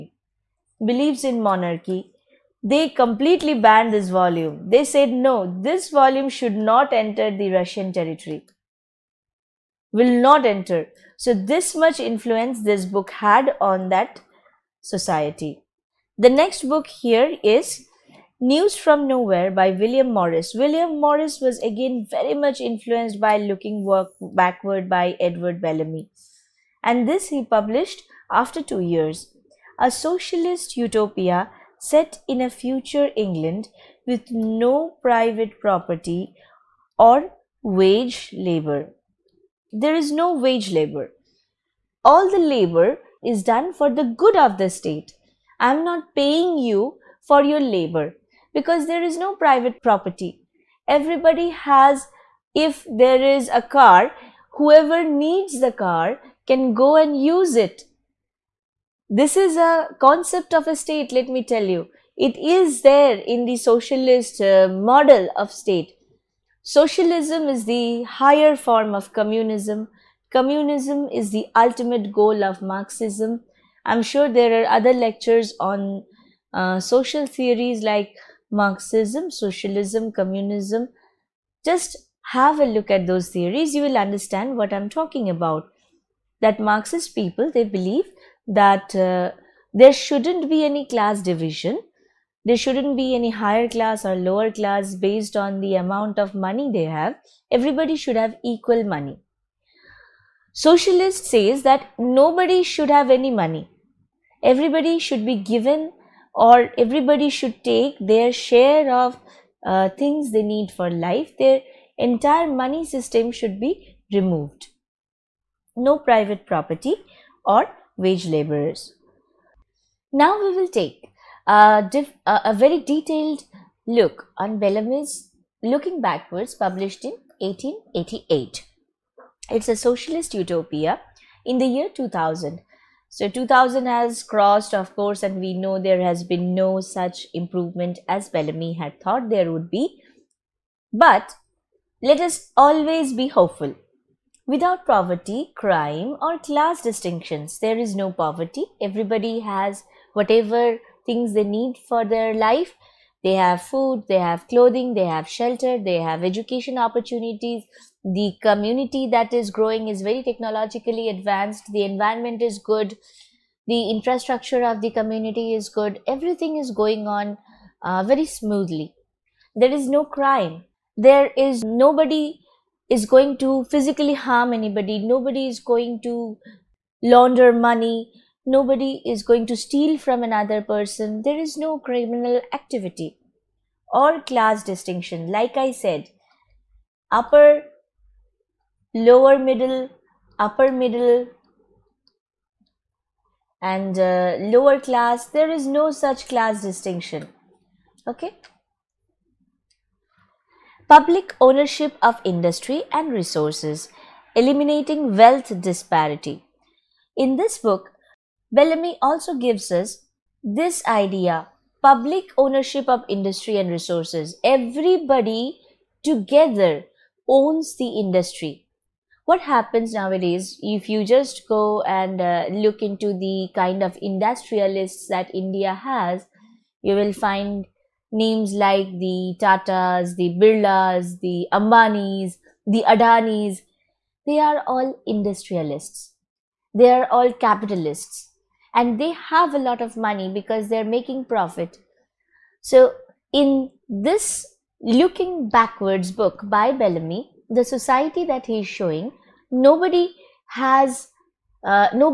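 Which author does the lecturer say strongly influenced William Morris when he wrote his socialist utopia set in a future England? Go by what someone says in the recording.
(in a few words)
Edward Bellamy.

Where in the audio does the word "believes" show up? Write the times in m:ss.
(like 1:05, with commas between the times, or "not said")
0:00, 1:27.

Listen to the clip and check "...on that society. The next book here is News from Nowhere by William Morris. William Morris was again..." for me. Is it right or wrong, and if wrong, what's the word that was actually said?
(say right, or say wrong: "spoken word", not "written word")
right.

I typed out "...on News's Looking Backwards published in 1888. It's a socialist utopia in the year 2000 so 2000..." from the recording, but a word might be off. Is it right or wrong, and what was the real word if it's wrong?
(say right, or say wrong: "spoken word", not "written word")
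wrong: "Bellamy", not "News".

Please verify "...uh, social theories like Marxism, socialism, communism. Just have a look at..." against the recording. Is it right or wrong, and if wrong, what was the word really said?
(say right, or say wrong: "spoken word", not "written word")
right.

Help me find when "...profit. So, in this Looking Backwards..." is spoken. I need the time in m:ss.
4:01.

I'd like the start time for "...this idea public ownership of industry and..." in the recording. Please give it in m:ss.
3:30.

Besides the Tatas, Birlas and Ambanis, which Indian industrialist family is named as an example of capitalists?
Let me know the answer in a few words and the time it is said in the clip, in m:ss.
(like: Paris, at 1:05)
The Adanis, at 3:52.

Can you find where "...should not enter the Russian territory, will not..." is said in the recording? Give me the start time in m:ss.
0:06.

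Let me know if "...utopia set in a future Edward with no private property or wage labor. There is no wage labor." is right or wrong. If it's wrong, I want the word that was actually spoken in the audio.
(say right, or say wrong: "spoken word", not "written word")
wrong: "England", not "Edward".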